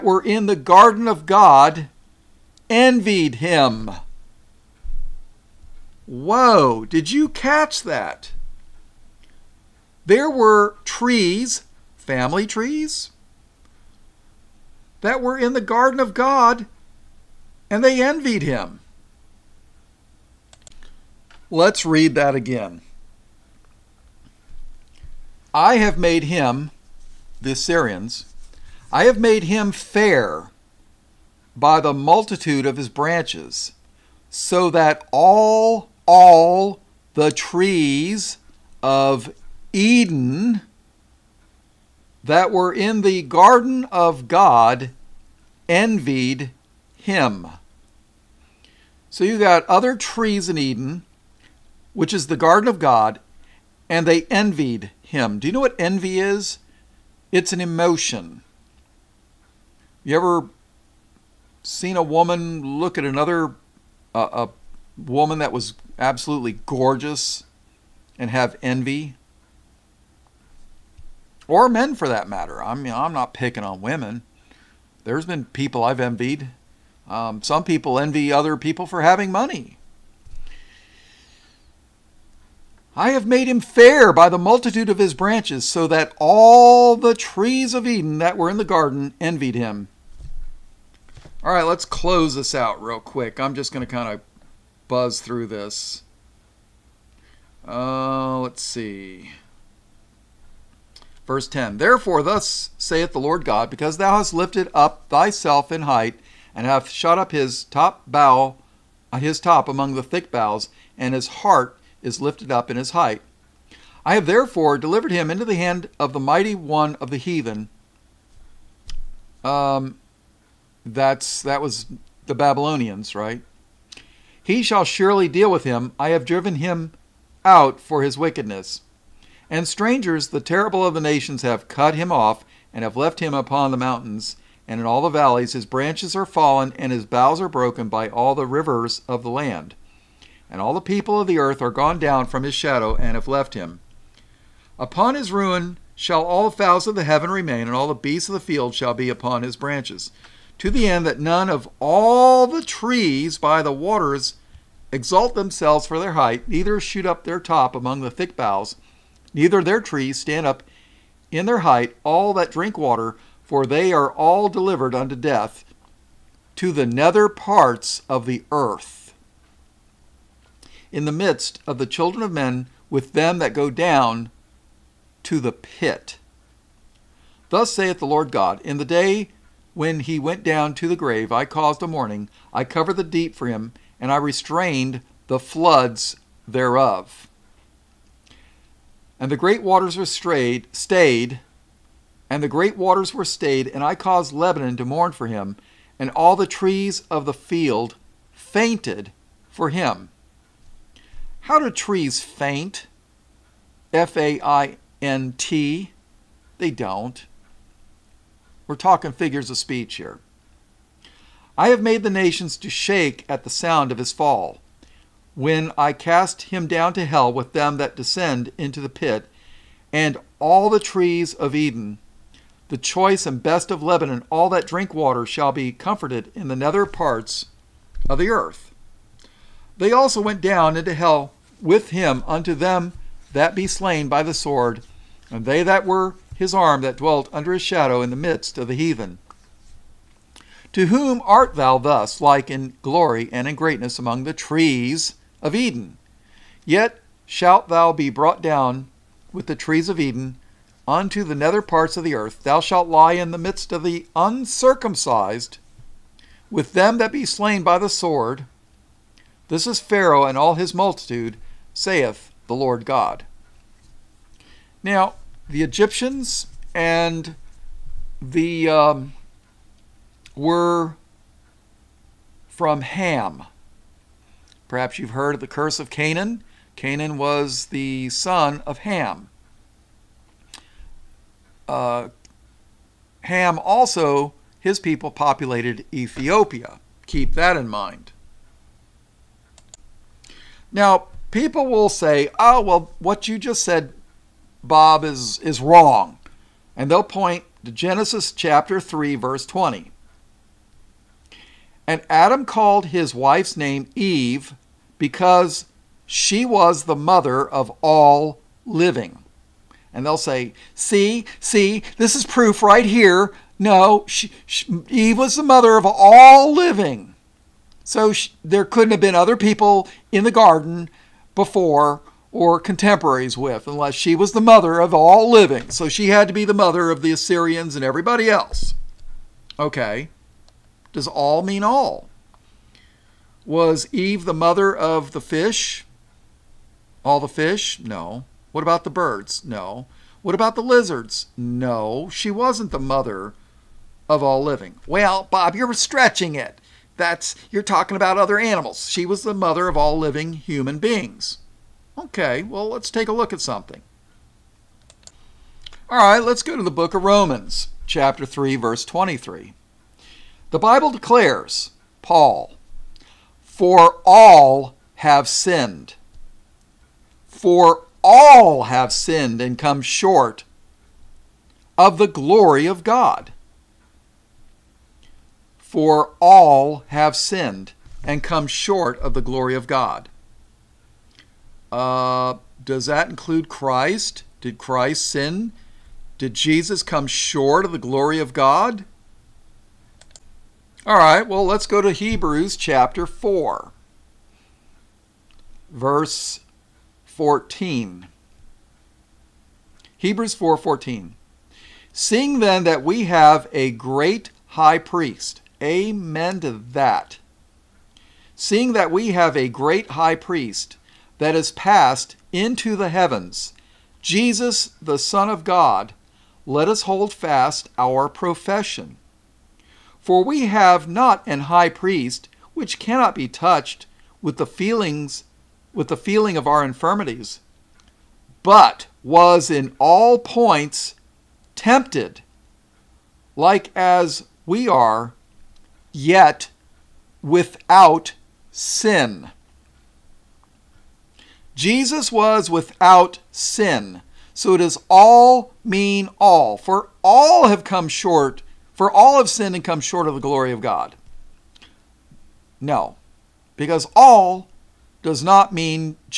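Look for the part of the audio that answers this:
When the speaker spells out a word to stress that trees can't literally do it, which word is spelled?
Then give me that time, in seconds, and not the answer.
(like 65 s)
203 s.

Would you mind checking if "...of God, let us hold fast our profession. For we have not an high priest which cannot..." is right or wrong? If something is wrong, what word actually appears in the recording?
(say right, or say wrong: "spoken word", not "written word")
right.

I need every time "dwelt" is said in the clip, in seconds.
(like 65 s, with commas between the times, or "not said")
236 s.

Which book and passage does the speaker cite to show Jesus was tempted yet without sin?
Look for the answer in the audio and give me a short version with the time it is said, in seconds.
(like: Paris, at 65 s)
Hebrews 4:14, at 399 s.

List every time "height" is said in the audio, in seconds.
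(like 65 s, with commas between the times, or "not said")
105 s, 112 s, 156 s, 161 s.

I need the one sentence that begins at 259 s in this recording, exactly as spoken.
This is Pharaoh and all his multitude saith the Lord God.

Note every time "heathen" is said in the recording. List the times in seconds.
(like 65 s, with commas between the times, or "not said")
117 s, 238 s.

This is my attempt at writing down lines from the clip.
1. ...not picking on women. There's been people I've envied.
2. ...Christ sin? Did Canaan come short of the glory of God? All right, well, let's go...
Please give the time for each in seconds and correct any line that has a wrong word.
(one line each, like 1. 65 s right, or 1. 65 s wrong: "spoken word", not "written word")
1. 73 s right
2. 384 s wrong: "Jesus", not "Canaan".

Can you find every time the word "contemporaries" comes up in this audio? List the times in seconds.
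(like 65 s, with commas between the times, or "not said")
322 s.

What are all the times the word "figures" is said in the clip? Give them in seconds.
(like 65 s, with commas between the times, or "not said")
209 s.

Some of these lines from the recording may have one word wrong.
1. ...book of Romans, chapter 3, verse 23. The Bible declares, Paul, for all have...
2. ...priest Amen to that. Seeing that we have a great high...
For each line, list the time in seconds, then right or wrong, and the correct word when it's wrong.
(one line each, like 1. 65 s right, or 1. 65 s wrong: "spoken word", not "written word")
1. 356 s right
2. 404 s right.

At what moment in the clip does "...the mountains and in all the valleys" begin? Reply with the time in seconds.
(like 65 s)
133 s.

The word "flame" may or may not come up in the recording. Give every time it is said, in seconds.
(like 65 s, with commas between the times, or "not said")
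not said.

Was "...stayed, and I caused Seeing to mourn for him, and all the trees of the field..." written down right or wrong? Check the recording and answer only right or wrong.
wrong.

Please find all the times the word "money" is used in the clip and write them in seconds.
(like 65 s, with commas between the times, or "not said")
79 s.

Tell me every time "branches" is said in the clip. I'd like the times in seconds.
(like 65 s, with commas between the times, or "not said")
32 s, 85 s, 135 s, 149 s.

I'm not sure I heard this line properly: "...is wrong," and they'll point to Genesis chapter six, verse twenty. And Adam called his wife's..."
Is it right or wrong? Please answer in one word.
wrong.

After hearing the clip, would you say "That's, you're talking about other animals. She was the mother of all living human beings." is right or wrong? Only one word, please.
right.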